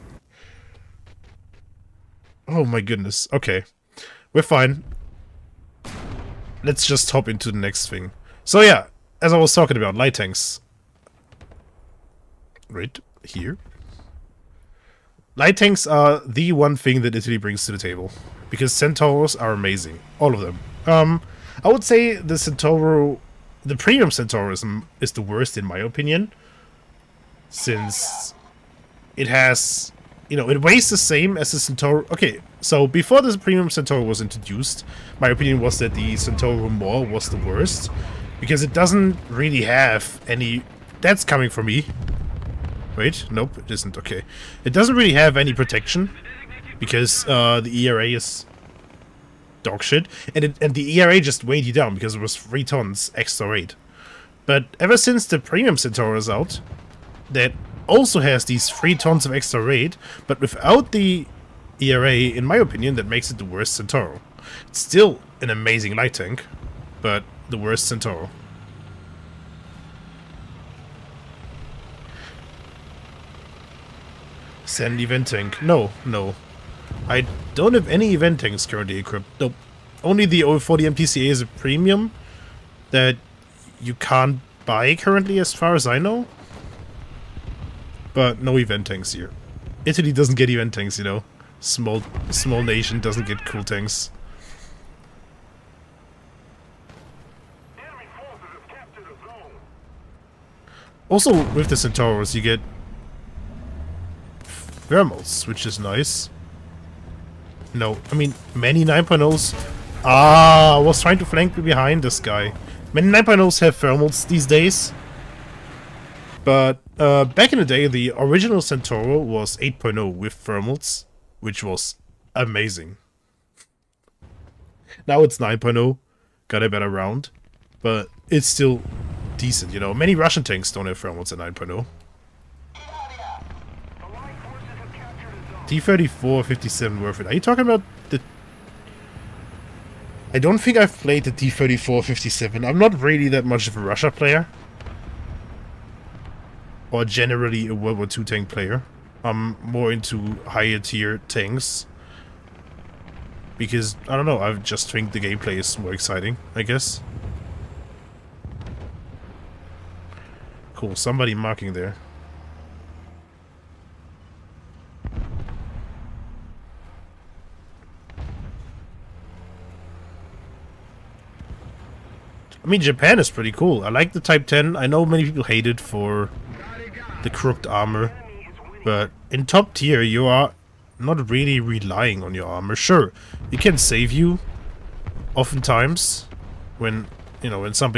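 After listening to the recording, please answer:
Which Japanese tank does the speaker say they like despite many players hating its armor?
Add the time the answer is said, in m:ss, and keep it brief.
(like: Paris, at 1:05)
Type 10, at 2:54.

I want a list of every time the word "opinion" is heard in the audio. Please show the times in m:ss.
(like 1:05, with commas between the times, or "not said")
0:25, 0:35, 1:02.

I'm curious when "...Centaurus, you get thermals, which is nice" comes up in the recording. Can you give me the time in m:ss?
1:41.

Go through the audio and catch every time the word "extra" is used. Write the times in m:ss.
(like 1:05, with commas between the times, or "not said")
0:53, 0:59.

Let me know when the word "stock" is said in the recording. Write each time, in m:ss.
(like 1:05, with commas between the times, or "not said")
not said.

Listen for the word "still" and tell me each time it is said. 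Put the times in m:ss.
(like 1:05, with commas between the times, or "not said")
1:04, 2:08.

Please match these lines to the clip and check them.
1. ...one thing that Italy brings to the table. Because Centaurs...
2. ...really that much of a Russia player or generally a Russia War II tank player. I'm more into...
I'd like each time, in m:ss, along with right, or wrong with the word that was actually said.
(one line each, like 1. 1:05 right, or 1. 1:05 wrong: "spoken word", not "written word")
1. 0:16 right
2. 2:23 wrong: "World", not "Russia".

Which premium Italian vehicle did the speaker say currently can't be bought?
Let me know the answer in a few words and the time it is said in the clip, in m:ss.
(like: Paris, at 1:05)
040 MTCA, at 1:20.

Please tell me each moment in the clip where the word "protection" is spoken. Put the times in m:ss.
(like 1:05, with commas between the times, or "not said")
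0:45.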